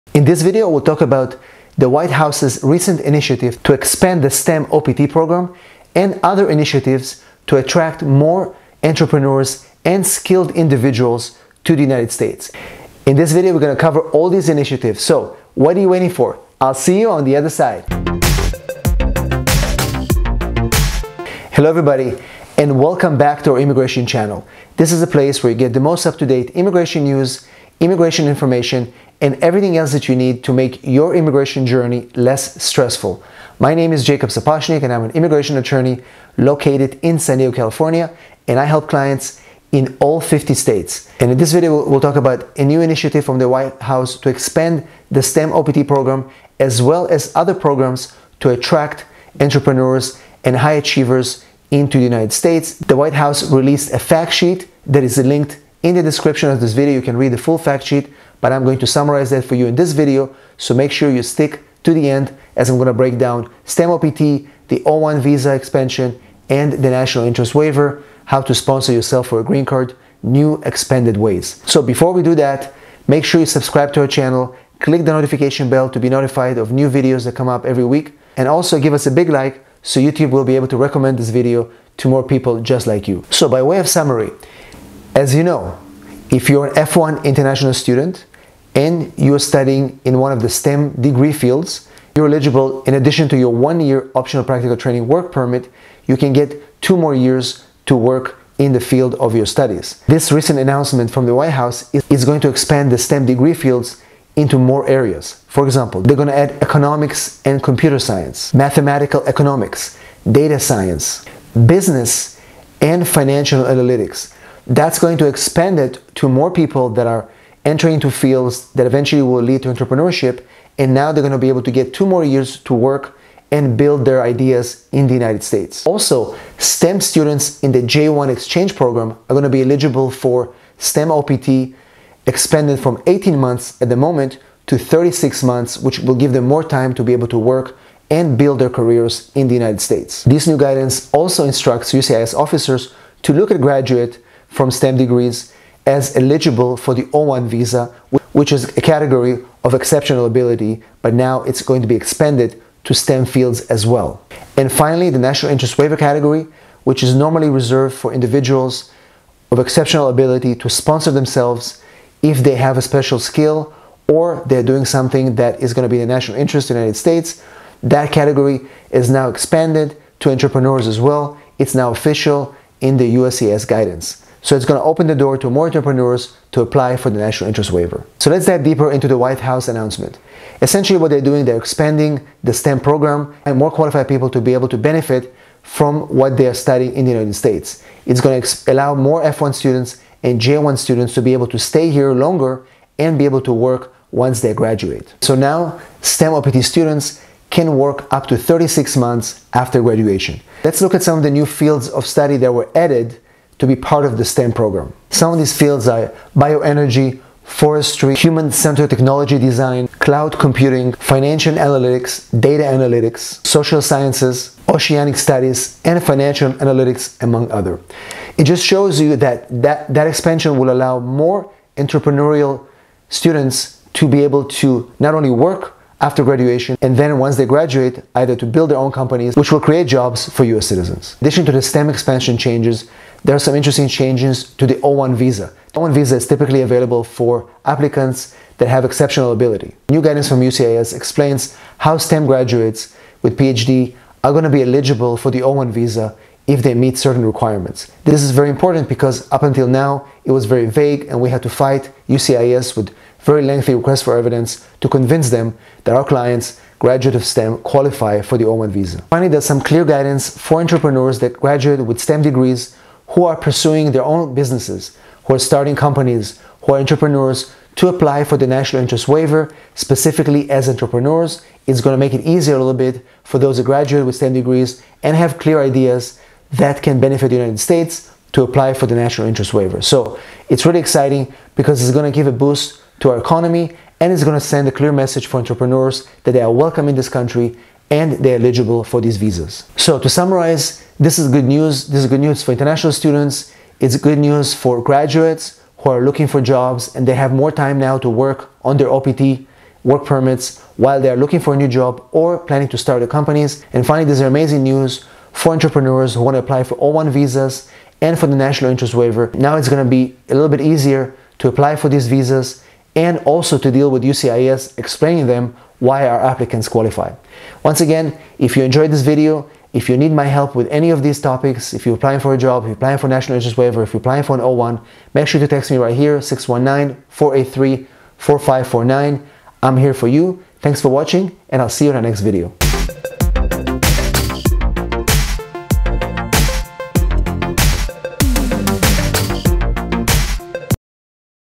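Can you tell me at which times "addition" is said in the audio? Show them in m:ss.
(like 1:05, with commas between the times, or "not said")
1:32, 3:51.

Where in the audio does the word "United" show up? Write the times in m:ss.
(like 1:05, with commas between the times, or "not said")
0:11, 0:52, 2:05, 2:19, 2:46, 3:07, 4:37.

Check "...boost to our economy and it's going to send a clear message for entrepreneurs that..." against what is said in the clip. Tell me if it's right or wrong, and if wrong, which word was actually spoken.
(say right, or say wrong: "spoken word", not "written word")
right.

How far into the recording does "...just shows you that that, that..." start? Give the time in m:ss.
3:38.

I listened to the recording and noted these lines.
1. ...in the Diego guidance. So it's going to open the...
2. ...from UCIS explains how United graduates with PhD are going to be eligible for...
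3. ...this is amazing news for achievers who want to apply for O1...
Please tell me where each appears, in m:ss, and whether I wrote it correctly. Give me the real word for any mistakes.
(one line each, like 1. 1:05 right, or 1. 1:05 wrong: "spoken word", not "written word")
1. 2:52 wrong: "USCIS", not "Diego"
2. 4:00 wrong: "STEM", not "United"
3. 5:04 wrong: "entrepreneurs", not "achievers".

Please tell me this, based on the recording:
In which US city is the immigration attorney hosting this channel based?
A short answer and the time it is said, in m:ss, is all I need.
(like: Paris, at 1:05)
San Diego, at 0:37.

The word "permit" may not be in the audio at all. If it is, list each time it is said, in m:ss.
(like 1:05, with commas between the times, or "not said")
1:35, 5:00.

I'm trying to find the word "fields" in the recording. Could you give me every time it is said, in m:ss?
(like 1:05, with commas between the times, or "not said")
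1:31, 1:38, 1:43, 1:58, 2:33, 3:21, 3:25.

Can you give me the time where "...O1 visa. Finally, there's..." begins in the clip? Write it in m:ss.
4:18.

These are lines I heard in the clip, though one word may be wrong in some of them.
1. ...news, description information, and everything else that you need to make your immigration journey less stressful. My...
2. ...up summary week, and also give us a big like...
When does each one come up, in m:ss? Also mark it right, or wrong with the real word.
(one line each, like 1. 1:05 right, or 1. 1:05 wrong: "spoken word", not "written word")
1. 0:27 wrong: "immigration", not "description"
2. 1:17 wrong: "every", not "summary".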